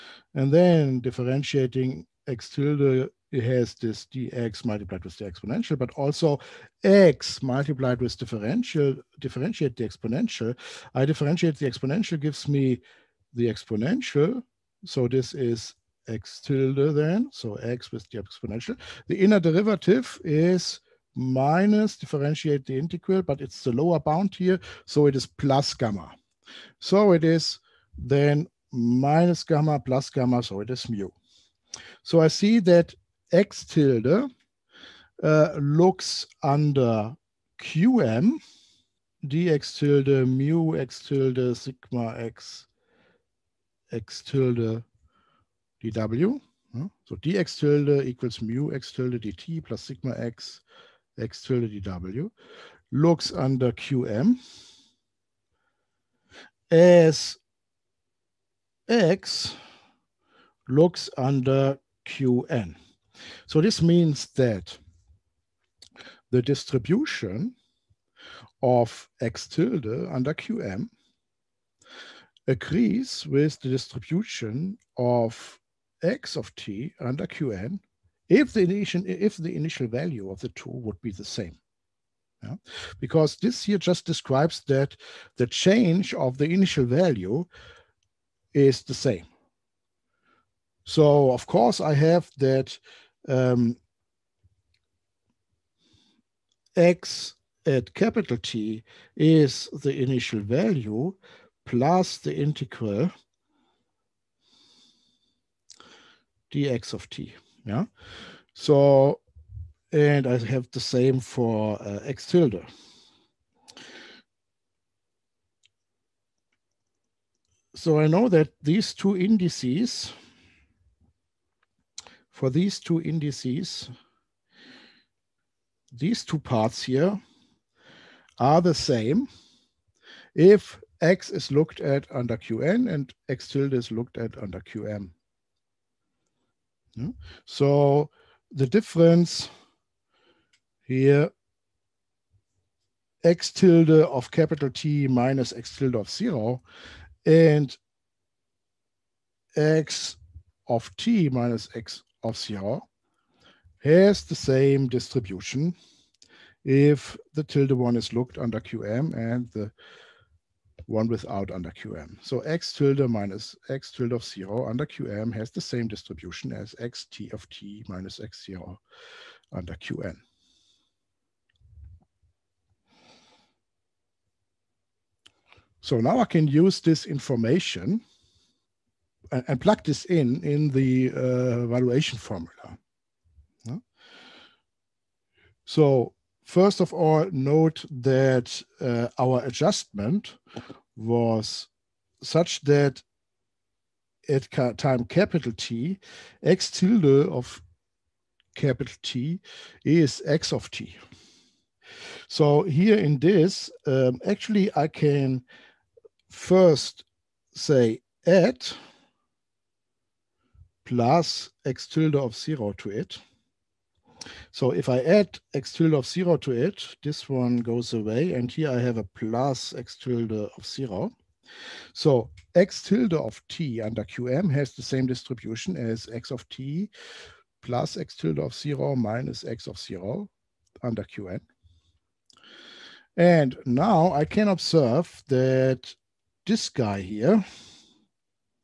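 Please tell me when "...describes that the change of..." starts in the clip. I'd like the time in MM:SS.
01:24.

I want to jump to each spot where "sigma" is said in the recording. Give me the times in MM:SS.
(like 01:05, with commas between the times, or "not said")
00:41, 00:49.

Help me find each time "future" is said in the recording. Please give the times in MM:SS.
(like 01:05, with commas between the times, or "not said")
not said.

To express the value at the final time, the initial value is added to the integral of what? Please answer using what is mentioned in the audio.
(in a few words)
dx of t.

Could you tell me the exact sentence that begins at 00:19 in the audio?
The inner derivative is minus differentiate the integral, but it's the lower bound here, so it is plus gamma.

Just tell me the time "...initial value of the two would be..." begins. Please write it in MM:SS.
01:19.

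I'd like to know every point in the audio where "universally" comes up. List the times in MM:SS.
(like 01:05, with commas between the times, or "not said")
not said.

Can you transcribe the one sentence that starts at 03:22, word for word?
So here in this, um, actually I can first say add plus x tilde of zero to it.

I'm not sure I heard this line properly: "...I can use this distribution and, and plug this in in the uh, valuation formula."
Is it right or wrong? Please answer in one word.
wrong.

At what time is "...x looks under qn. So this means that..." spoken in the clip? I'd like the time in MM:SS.
00:58.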